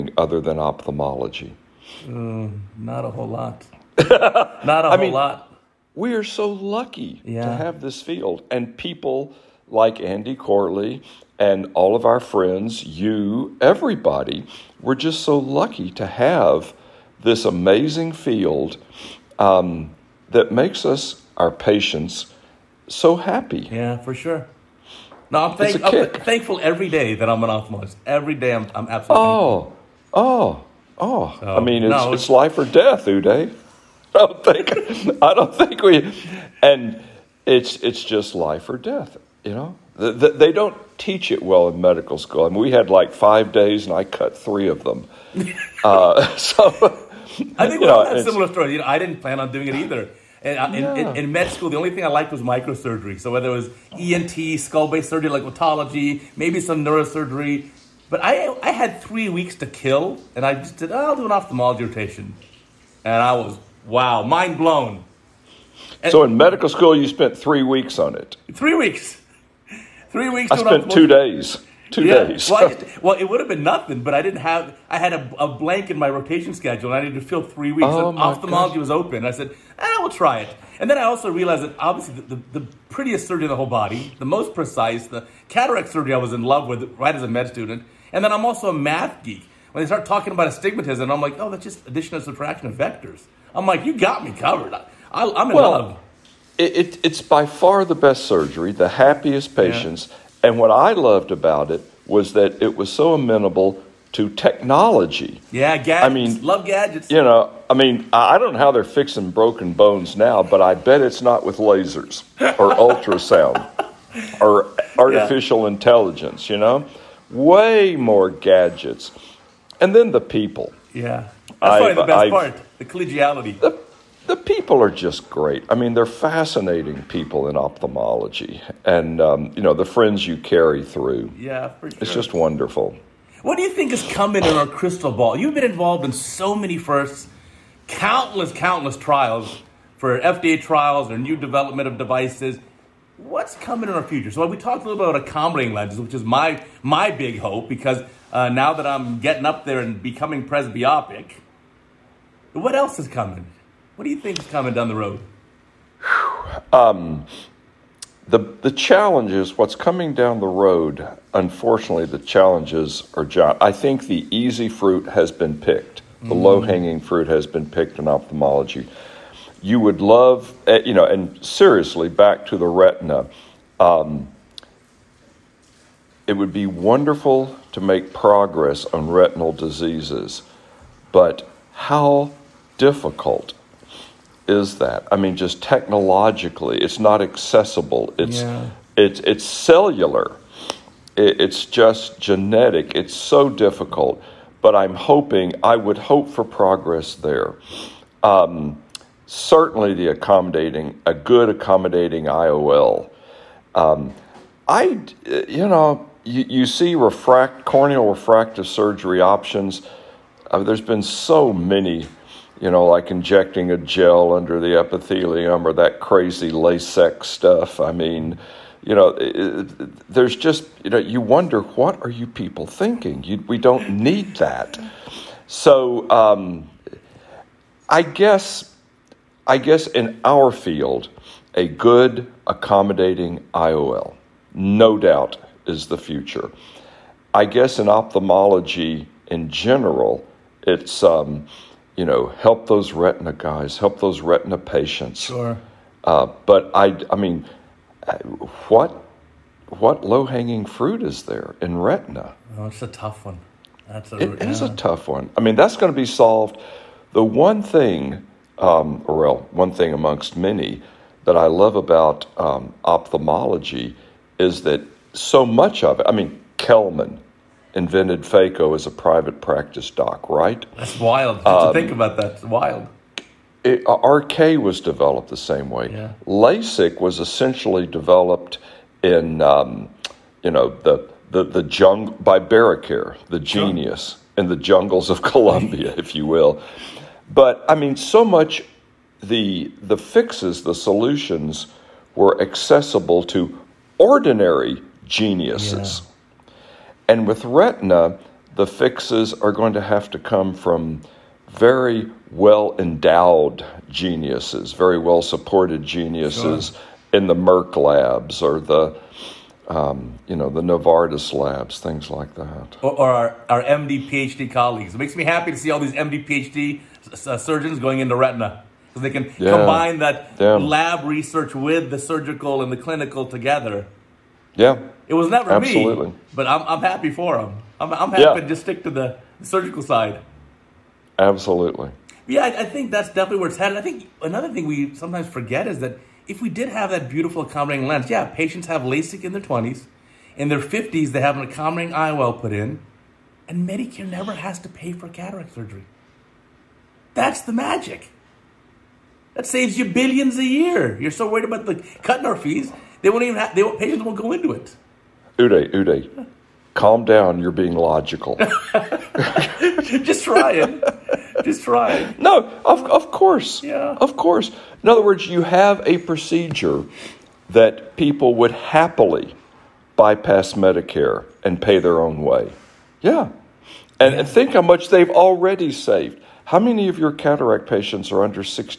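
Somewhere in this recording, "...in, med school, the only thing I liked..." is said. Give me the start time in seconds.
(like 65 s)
51 s.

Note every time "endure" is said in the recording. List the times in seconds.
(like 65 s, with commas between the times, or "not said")
not said.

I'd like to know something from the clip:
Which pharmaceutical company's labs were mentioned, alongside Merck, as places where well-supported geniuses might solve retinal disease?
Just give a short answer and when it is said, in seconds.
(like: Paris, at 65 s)
Novartis, at 310 s.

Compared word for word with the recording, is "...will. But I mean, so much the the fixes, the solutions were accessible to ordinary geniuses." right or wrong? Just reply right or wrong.
right.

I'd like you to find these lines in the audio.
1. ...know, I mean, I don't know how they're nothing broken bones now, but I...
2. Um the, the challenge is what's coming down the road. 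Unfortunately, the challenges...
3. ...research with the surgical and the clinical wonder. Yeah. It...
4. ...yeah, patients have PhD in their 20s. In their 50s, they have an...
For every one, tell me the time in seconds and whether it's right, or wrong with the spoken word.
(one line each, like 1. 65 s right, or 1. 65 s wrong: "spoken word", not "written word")
1. 107 s wrong: "fixing", not "nothing"
2. 156 s right
3. 321 s wrong: "together", not "wonder"
4. 338 s wrong: "LASIK", not "PhD".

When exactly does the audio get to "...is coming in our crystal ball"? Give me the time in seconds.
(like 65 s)
133 s.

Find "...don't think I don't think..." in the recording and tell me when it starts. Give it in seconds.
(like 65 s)
34 s.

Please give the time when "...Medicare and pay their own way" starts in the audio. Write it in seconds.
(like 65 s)
370 s.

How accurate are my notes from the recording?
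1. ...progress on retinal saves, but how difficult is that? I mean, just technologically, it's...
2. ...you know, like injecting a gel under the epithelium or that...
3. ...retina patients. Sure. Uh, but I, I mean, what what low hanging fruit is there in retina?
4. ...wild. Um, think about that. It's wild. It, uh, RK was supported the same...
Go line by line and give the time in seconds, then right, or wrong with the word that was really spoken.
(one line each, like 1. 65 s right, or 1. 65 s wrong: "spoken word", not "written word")
1. 178 s wrong: "diseases", not "saves"
2. 212 s right
3. 244 s right
4. 270 s wrong: "developed", not "supported".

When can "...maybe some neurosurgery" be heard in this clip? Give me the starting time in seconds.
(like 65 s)
56 s.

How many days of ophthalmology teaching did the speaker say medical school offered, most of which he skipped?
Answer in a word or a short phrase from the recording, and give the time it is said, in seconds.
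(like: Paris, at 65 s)
5, at 43 s.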